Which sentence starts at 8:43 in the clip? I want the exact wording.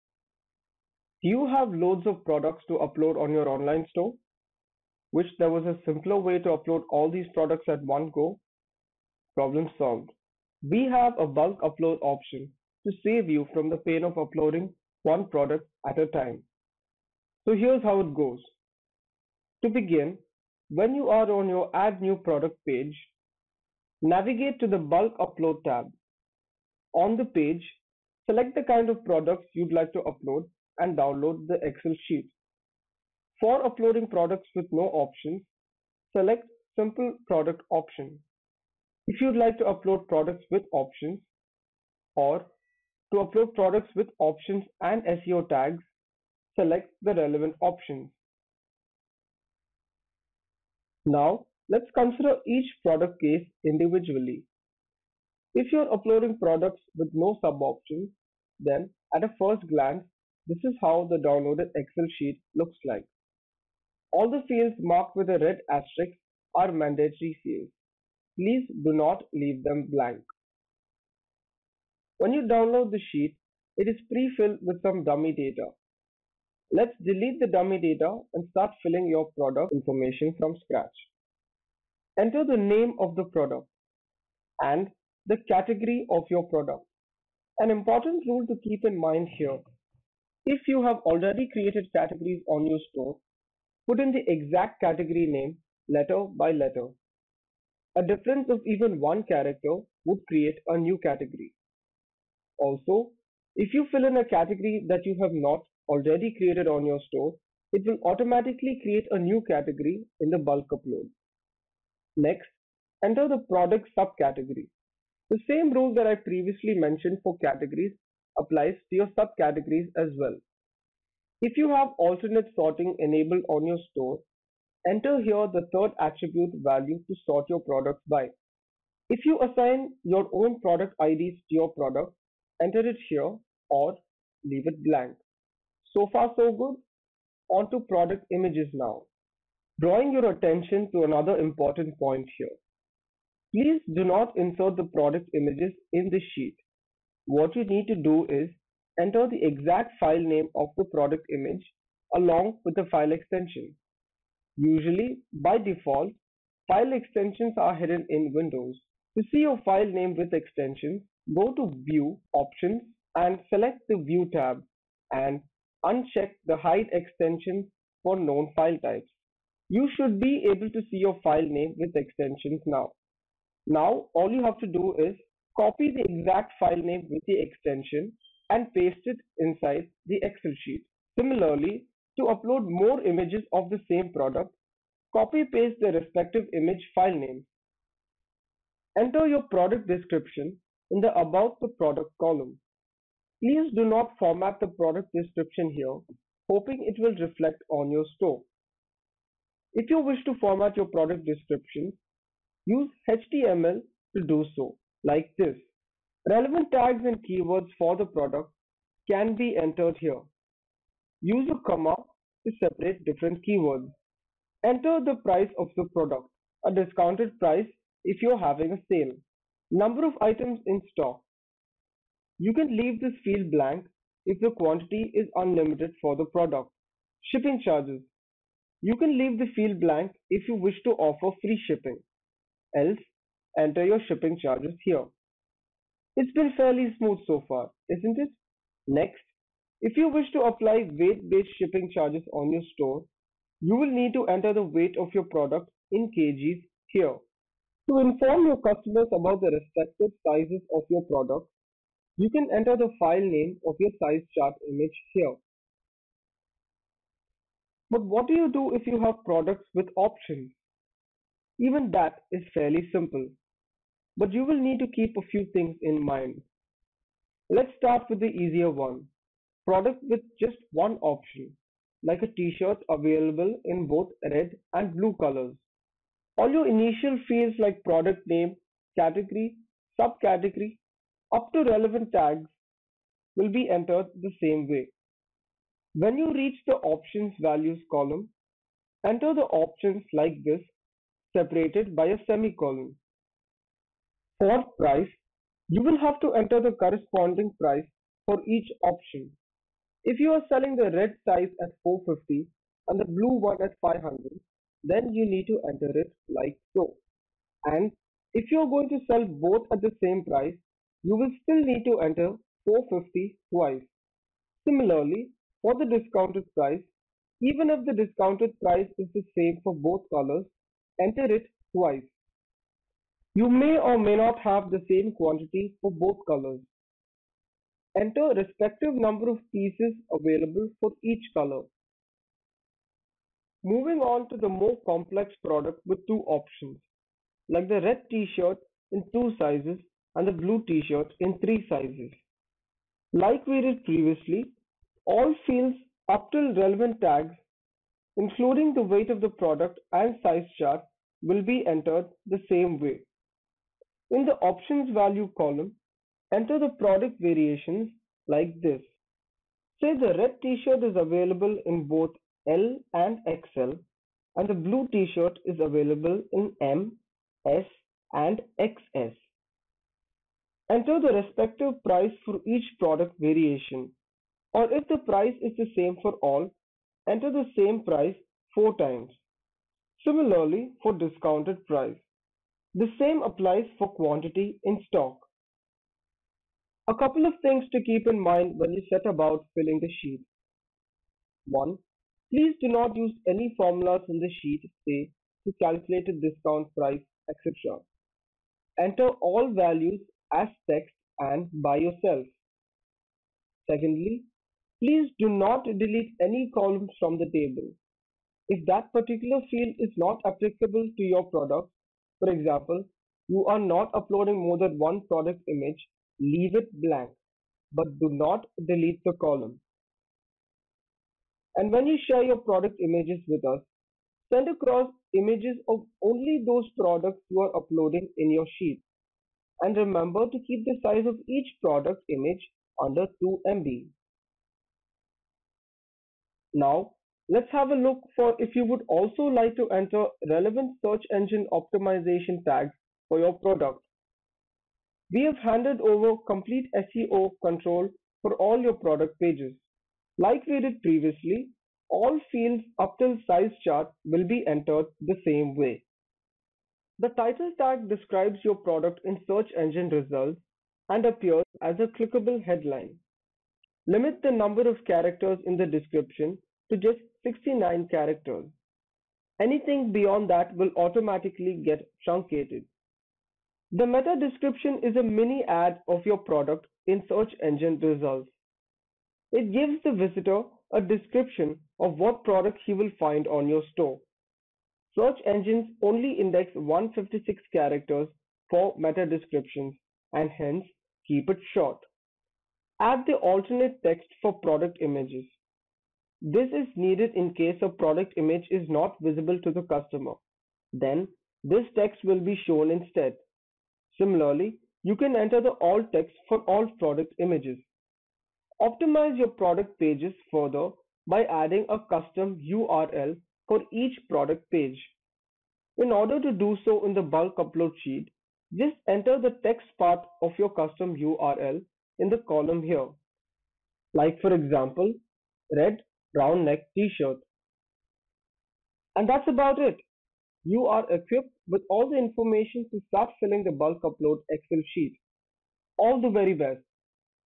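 Like for example, red brown neck t-shirt.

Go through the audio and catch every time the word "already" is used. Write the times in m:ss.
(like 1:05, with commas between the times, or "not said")
1:31, 1:45.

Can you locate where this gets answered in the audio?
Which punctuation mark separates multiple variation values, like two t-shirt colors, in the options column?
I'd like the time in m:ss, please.
4:52.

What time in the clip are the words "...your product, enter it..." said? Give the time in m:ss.
2:11.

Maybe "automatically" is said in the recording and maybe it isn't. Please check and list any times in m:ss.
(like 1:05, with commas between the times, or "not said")
1:48, 7:50.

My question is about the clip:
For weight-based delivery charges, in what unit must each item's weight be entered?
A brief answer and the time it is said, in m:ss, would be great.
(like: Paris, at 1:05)
kgs, at 4:06.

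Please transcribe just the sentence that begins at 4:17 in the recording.
But what do you do if you have products with options?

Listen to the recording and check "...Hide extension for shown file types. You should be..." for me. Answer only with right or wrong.
wrong.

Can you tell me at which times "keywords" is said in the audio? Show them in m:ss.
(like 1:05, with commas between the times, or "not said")
3:27, 3:33.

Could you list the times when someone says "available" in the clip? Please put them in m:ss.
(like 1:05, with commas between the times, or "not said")
4:32, 5:30, 6:00, 6:05.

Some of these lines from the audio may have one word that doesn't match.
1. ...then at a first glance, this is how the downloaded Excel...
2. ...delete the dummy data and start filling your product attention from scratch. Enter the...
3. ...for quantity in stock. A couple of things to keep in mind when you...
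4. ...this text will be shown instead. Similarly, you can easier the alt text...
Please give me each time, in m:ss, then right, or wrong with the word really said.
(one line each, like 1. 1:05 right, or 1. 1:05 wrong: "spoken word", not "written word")
1. 0:58 right
2. 1:17 wrong: "information", not "attention"
3. 6:23 right
4. 8:21 wrong: "enter", not "easier".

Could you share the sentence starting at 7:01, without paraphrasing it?
And when you share your product images with us, send across images of only those products you are uploading in your sheet.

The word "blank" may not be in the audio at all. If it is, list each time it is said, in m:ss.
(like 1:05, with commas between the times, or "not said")
1:09, 2:14, 3:43, 3:49, 6:56.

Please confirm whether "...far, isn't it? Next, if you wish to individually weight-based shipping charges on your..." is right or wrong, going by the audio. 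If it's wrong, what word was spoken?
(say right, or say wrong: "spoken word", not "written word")
wrong: "apply", not "individually".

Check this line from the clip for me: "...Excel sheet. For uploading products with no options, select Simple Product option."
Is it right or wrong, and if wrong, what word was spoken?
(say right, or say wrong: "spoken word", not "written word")
right.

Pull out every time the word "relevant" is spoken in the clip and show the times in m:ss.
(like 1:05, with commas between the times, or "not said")
0:47, 3:26, 4:41, 5:46, 7:20.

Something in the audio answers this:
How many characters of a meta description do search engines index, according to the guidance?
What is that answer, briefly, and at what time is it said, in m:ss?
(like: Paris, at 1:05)
156, at 8:06.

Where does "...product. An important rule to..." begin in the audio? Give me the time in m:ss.
1:26.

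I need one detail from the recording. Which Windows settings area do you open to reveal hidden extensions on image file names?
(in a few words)
View Options.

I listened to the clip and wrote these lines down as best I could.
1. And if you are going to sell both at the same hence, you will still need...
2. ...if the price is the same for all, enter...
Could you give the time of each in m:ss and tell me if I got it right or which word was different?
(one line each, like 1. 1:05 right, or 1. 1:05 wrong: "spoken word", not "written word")
1. 5:07 wrong: "price", not "hence"
2. 6:14 right.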